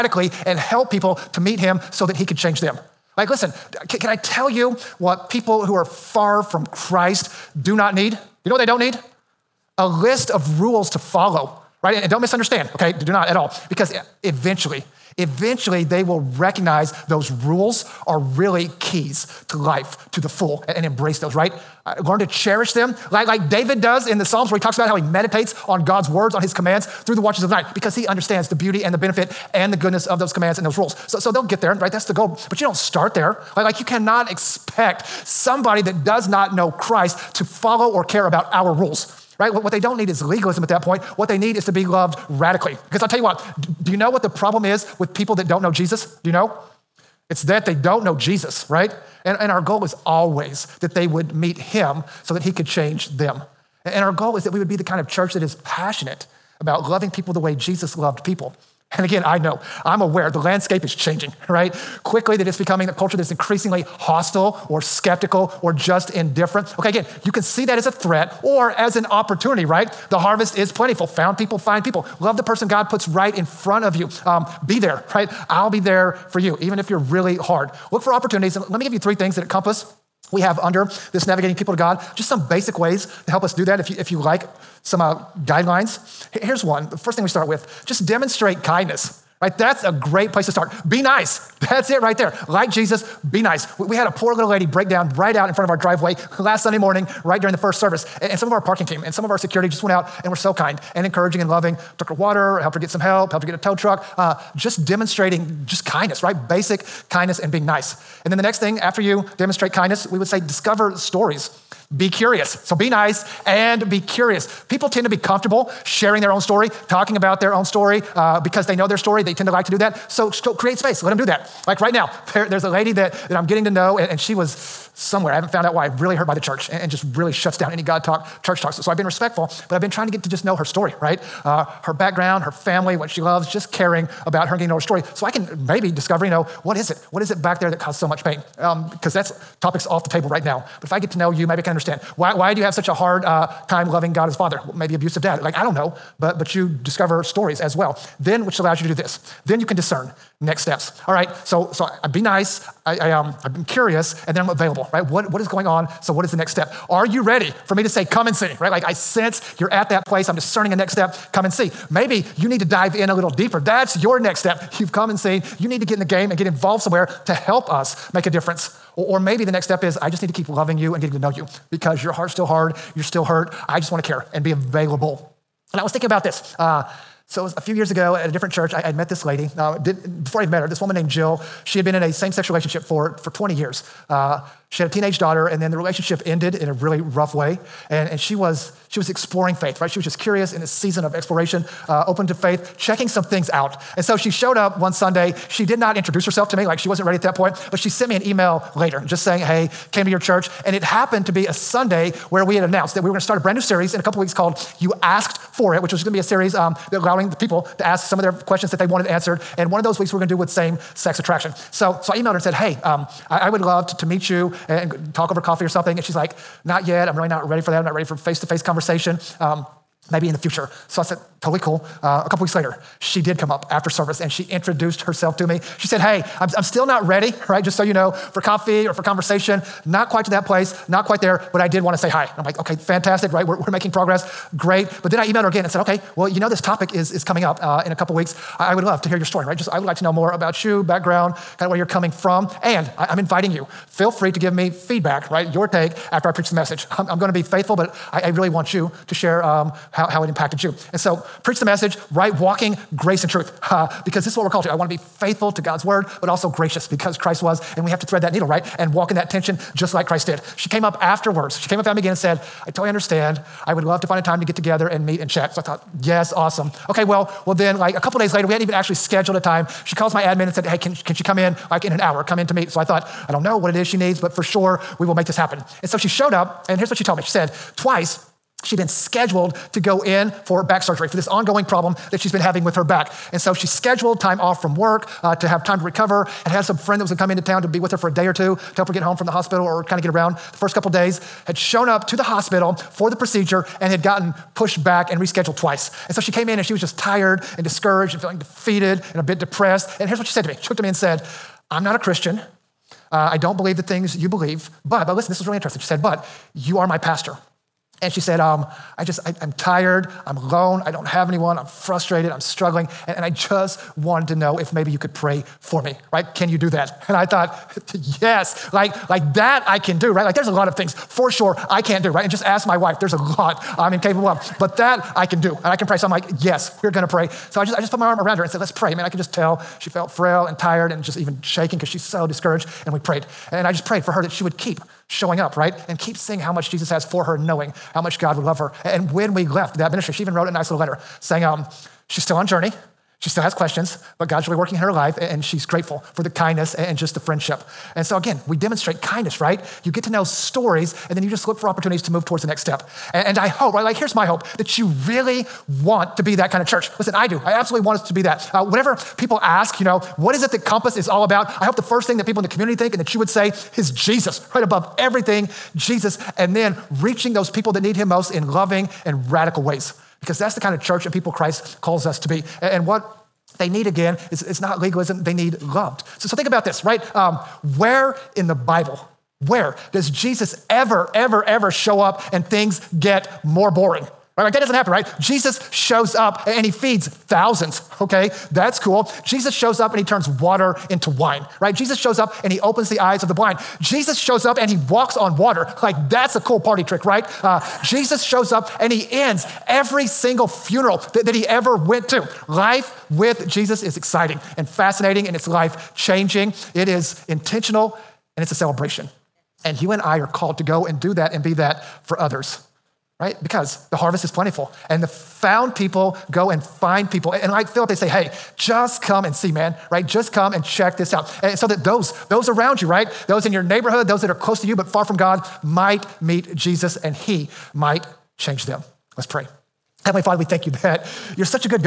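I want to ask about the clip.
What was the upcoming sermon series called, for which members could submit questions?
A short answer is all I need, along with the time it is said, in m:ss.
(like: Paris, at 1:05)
You Asked for It, at 3:24.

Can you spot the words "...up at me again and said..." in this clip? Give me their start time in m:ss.
4:21.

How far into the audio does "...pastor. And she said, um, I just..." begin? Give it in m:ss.
5:06.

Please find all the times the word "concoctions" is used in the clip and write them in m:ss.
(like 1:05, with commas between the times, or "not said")
not said.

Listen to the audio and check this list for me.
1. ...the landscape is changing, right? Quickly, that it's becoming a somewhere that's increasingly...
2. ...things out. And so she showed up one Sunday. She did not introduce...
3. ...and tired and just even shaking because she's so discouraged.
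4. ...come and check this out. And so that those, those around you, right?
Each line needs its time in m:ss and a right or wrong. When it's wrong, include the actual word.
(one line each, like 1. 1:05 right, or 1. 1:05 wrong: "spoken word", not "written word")
1. 1:00 wrong: "culture", not "somewhere"
2. 3:13 right
3. 5:30 right
4. 7:00 right.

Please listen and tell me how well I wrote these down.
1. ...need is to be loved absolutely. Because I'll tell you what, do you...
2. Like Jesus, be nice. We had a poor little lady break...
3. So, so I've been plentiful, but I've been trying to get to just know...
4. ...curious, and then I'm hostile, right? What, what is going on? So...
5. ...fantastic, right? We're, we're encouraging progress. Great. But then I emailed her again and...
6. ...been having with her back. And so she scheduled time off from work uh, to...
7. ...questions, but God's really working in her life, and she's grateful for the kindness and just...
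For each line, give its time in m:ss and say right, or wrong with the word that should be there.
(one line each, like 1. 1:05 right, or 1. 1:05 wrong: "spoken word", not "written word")
1. 0:41 wrong: "radically", not "absolutely"
2. 1:32 right
3. 2:08 wrong: "respectful", not "plentiful"
4. 2:33 wrong: "available", not "hostile"
5. 3:52 wrong: "making", not "encouraging"
6. 4:42 right
7. 5:43 right.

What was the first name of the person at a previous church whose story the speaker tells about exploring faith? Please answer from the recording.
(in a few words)
Jill.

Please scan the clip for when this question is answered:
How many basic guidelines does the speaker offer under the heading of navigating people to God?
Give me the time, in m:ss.
1:18.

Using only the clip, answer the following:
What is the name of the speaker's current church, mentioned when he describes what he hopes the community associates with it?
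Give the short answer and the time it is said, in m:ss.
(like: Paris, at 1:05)
Compass, at 6:00.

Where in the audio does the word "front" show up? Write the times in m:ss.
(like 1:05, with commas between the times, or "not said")
1:13, 1:35.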